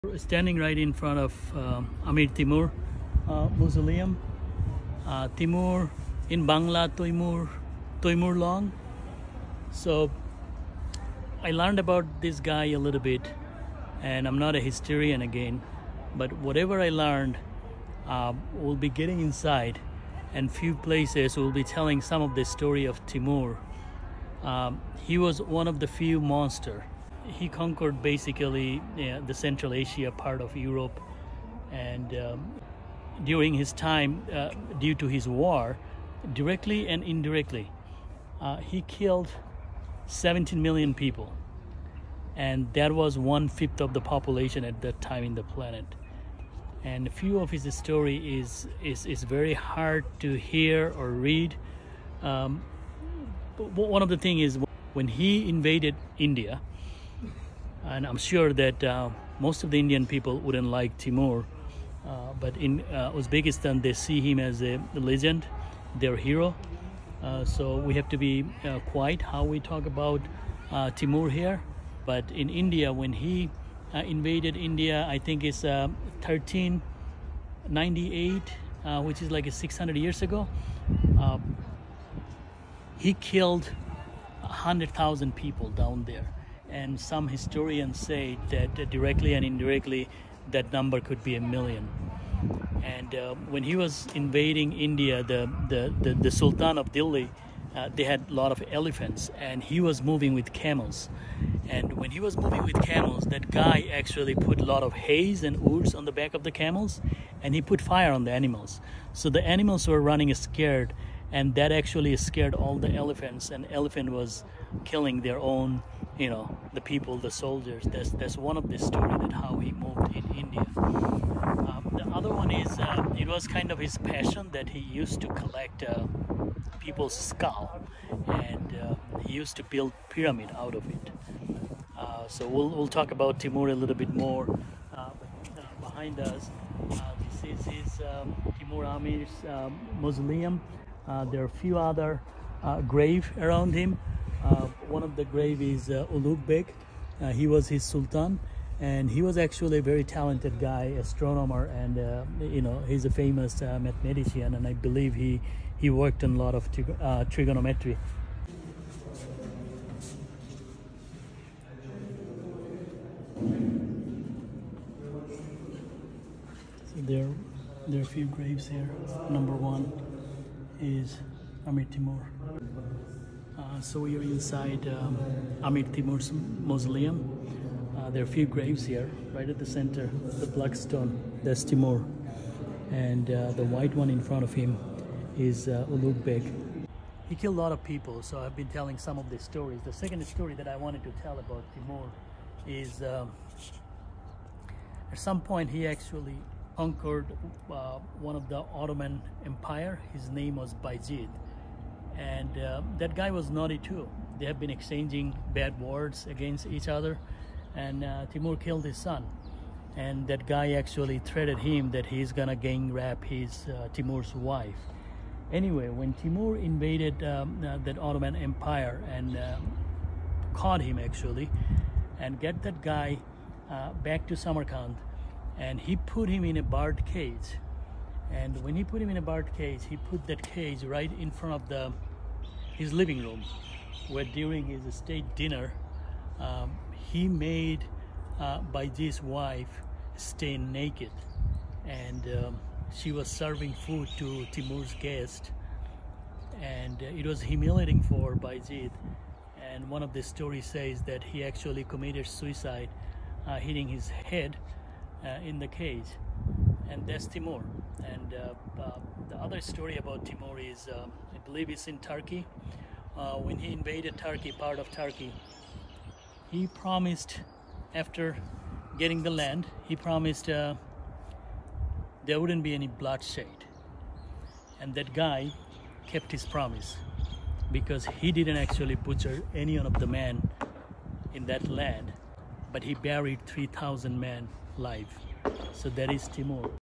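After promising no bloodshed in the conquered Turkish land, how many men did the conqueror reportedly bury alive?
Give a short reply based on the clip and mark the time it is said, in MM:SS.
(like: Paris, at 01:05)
3,000, at 04:43.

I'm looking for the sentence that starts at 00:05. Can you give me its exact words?
Uh, Timur in Bangla, Toimur, Toimur Long.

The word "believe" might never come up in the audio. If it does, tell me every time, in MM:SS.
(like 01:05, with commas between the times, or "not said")
02:34, 04:21.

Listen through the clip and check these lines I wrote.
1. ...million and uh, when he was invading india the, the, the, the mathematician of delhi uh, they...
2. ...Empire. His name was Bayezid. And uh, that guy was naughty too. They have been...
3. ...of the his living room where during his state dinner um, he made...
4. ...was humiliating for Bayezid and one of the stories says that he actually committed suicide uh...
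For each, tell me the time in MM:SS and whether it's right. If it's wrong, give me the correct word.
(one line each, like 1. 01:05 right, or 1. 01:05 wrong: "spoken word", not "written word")
1. 01:31 wrong: "sultan", not "mathematician"
2. 03:19 right
3. 03:51 right
4. 04:07 right.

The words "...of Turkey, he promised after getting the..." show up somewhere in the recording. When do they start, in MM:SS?
04:24.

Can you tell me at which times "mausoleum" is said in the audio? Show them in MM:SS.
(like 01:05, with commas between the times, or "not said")
00:03, 02:20, 02:56.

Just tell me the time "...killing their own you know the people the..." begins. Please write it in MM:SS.
01:54.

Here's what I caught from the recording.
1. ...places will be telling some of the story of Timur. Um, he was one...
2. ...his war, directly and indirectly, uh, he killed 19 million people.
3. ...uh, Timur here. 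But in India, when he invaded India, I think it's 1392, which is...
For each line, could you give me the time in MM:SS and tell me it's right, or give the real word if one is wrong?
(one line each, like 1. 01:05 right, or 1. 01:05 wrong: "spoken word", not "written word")
1. 00:20 right
2. 00:35 wrong: "17", not "19"
3. 01:10 wrong: "1398", not "1392".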